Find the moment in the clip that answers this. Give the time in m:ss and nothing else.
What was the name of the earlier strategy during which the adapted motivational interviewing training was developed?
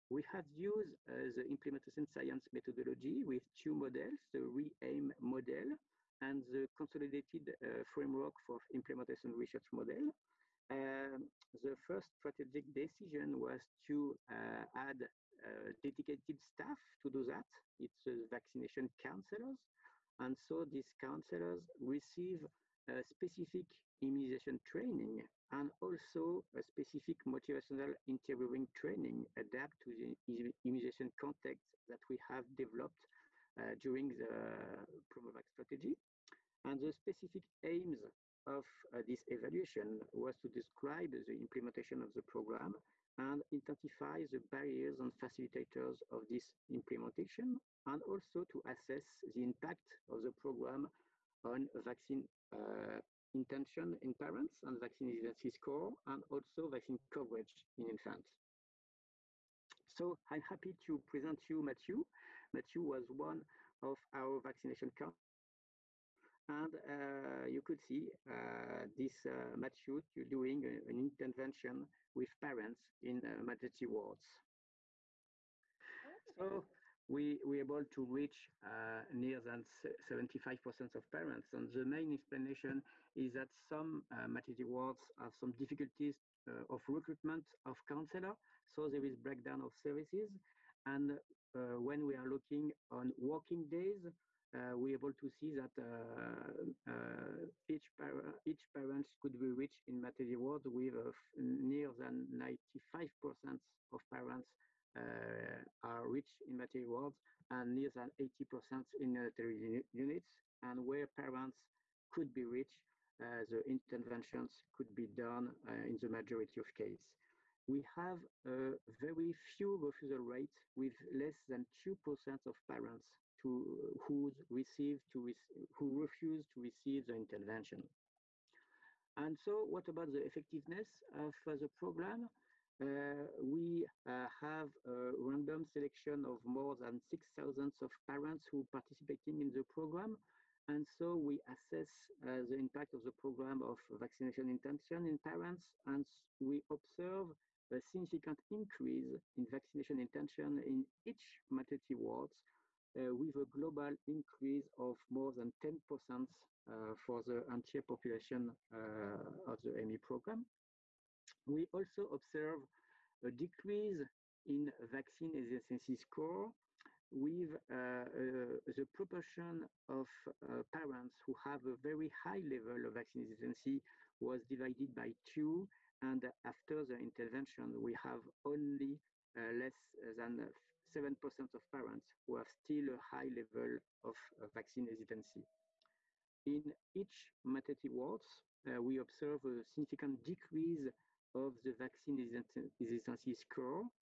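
0:35.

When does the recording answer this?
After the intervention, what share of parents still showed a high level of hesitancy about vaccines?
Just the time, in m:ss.
2:59.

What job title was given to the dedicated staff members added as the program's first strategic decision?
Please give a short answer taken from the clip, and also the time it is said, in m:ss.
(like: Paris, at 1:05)
Vaccination counselors, at 0:18.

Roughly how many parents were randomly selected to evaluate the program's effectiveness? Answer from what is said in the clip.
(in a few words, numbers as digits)
More than 6,000.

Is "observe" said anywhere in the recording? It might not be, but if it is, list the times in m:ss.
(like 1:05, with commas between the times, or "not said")
2:26, 2:42, 3:08.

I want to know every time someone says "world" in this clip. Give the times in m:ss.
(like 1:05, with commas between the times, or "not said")
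1:40, 1:46.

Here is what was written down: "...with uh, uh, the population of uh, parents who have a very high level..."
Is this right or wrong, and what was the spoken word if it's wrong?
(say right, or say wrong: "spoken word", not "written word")
wrong: "proportion", not "population".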